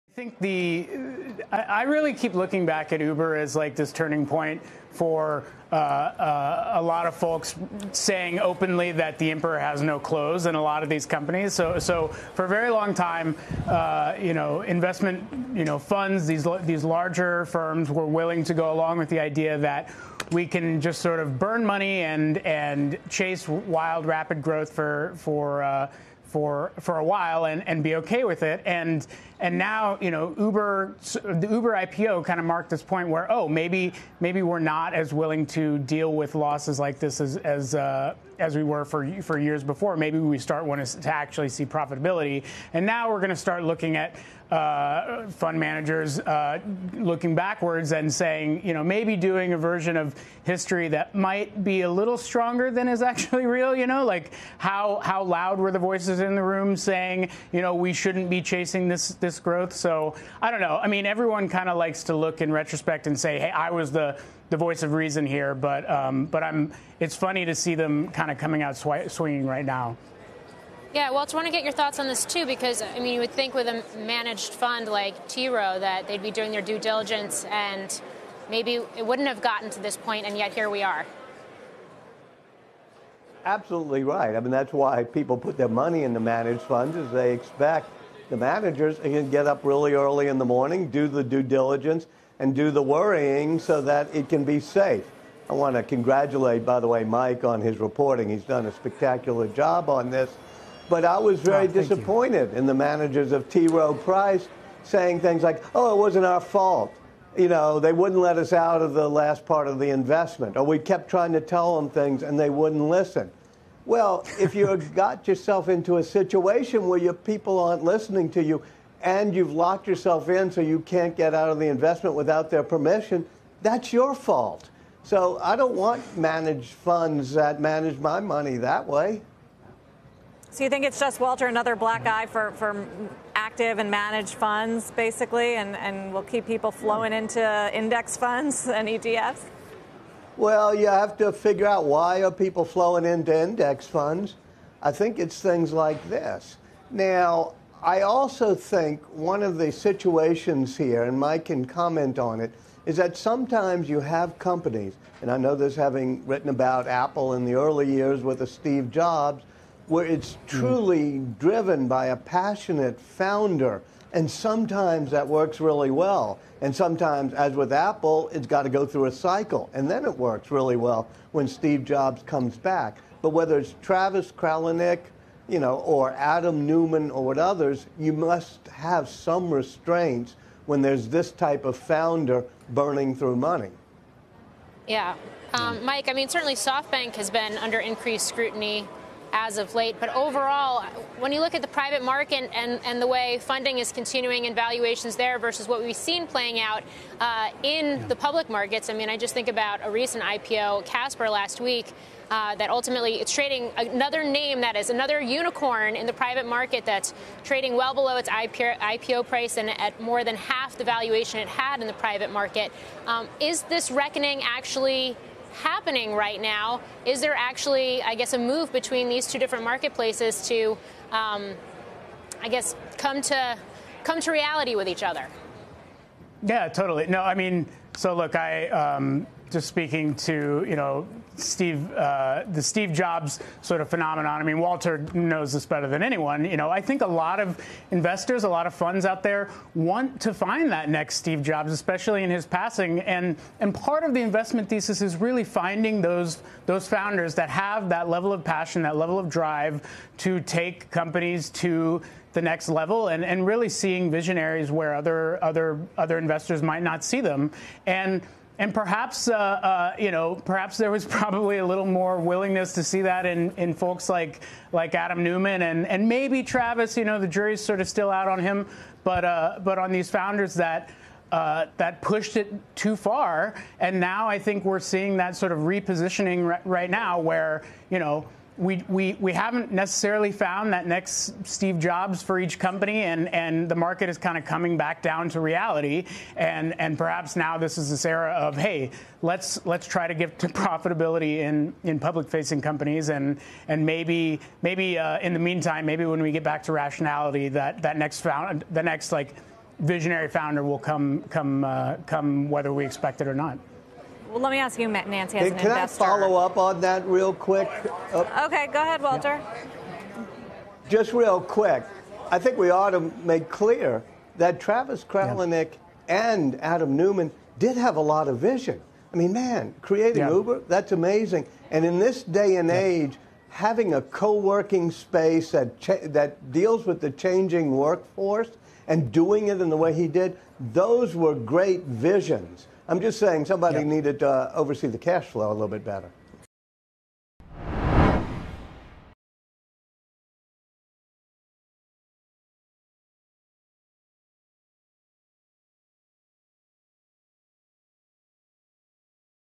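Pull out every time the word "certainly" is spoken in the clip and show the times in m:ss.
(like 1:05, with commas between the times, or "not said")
3:06.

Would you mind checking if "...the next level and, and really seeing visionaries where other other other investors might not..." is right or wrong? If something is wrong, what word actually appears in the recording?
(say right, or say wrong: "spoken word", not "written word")
right.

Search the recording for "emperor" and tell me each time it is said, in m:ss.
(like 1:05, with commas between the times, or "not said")
0:09.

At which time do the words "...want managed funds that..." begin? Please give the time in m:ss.
2:05.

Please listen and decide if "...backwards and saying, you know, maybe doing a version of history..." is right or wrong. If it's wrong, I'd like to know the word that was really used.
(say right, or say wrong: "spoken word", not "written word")
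right.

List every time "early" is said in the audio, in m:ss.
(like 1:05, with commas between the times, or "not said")
1:29, 2:37.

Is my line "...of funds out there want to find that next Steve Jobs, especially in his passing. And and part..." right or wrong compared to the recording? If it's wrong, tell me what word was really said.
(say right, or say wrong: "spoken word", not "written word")
right.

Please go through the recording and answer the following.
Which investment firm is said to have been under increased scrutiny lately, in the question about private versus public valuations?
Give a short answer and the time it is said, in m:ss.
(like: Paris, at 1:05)
SoftBank, at 3:06.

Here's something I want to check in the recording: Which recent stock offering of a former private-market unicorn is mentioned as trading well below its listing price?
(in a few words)
Casper.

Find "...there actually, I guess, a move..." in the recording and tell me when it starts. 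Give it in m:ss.
3:37.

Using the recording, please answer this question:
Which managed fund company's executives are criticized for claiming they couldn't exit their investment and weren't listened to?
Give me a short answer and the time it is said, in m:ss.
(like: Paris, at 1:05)
T. Rowe Price, at 1:43.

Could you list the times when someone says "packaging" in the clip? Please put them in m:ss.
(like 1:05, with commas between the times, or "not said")
not said.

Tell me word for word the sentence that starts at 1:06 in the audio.
It's funny to see them kind of coming out sw- swinging right now.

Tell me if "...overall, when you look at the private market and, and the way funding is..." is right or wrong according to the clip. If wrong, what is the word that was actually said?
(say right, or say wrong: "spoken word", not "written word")
right.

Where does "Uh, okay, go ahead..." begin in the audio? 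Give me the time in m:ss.
5:08.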